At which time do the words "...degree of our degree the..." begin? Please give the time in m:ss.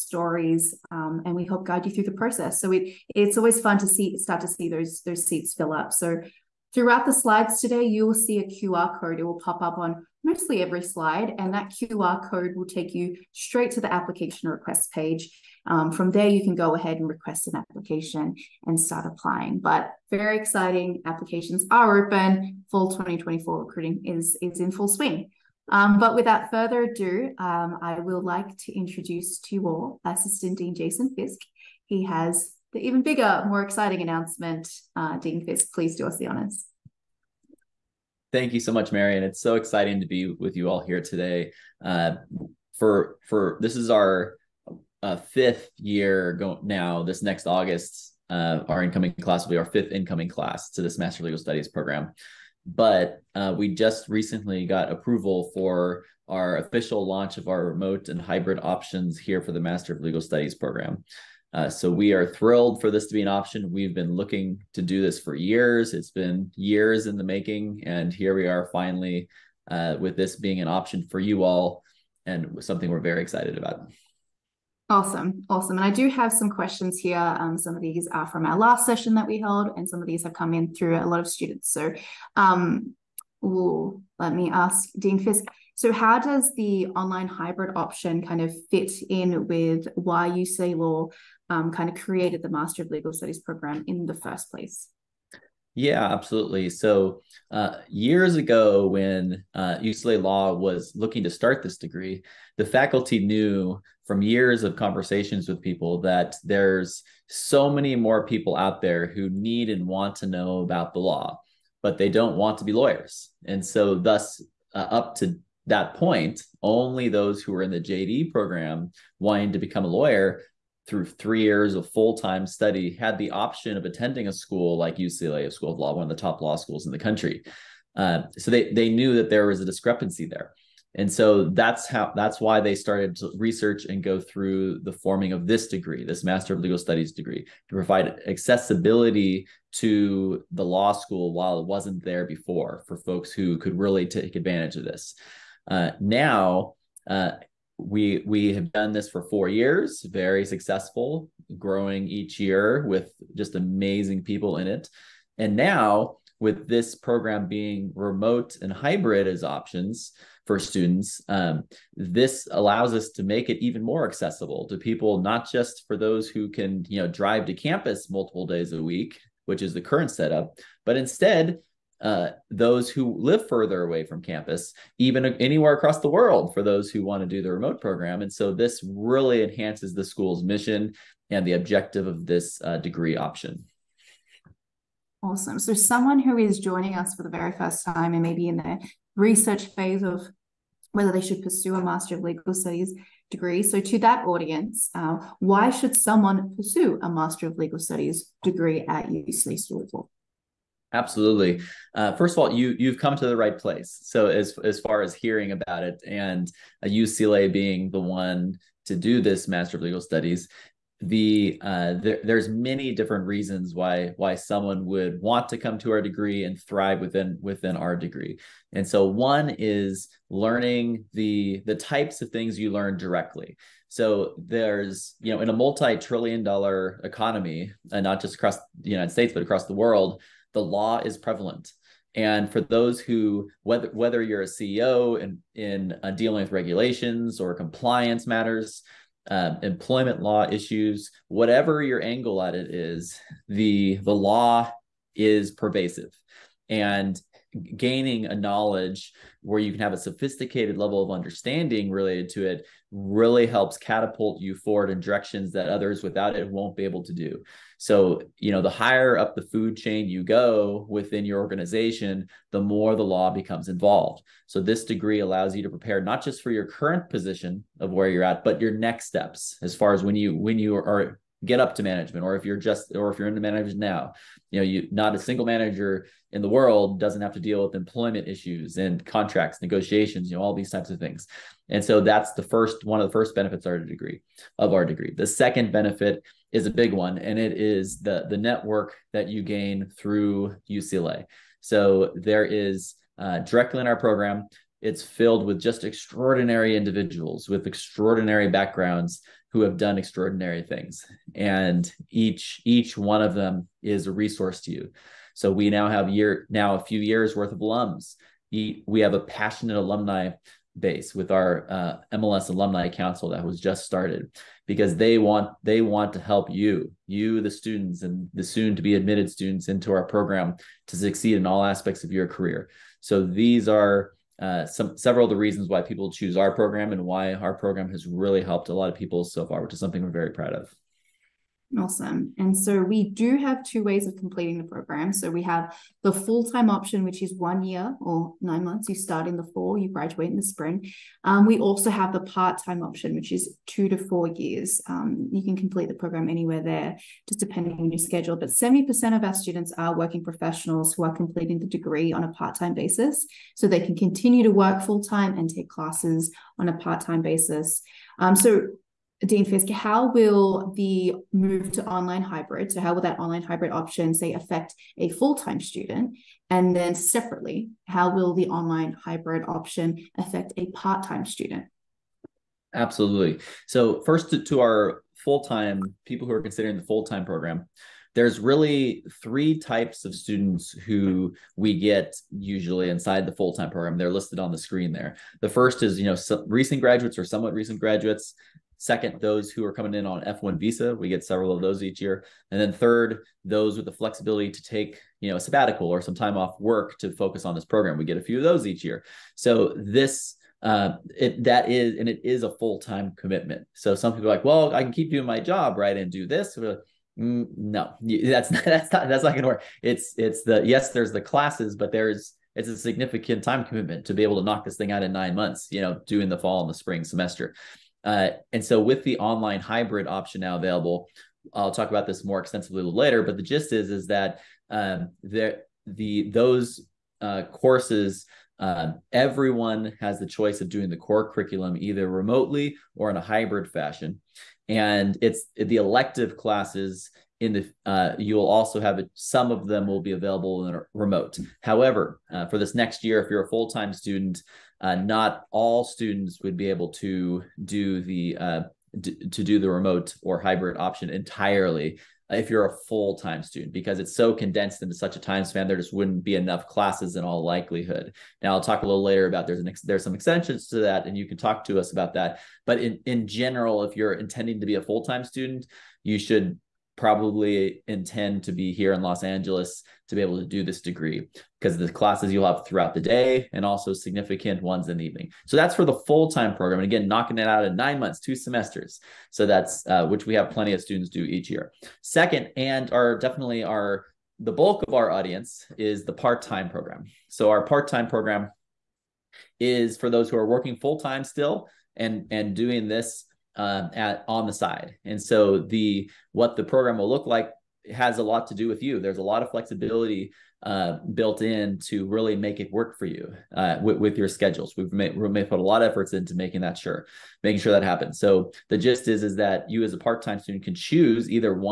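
4:43.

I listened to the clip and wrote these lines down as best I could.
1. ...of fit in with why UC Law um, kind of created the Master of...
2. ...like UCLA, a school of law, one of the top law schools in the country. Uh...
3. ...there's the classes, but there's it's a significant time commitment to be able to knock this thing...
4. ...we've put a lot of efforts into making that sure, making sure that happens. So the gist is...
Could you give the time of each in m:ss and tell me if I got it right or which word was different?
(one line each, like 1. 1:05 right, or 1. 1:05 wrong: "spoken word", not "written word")
1. 1:28 right
2. 2:04 right
3. 6:50 right
4. 8:25 right.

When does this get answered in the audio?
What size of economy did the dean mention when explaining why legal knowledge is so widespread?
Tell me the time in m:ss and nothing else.
3:45.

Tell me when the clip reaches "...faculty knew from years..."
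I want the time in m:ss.
1:42.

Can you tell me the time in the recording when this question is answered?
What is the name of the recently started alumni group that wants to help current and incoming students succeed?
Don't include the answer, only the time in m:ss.
5:12.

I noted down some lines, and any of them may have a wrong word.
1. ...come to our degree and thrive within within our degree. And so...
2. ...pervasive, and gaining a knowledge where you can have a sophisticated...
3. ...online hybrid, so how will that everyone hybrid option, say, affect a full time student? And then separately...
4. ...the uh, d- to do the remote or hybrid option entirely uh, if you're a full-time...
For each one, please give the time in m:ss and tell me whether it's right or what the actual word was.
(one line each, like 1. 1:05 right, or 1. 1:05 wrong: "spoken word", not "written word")
1. 3:35 right
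2. 4:05 right
3. 6:01 wrong: "online", not "everyone"
4. 7:28 right.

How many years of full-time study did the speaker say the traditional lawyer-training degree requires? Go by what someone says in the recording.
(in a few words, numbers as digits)
3 years.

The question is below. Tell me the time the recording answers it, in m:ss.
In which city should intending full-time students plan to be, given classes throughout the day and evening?
7:49.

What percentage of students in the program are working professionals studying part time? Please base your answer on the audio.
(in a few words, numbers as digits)
70%.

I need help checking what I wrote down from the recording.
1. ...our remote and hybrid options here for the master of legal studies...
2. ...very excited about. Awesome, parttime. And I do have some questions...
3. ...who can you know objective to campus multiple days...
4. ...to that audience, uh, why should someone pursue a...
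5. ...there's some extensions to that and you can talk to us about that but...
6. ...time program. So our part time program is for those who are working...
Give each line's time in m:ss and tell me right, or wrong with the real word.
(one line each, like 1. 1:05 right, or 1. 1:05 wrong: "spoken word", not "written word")
1. 0:57 right
2. 1:13 wrong: "awesome", not "parttime"
3. 2:46 wrong: "drive", not "objective"
4. 3:13 right
5. 7:39 right
6. 8:06 right.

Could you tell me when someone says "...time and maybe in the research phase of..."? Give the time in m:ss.
3:07.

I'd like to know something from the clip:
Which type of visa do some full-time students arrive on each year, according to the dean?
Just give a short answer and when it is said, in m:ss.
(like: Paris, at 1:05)
F1 visa, at 6:30.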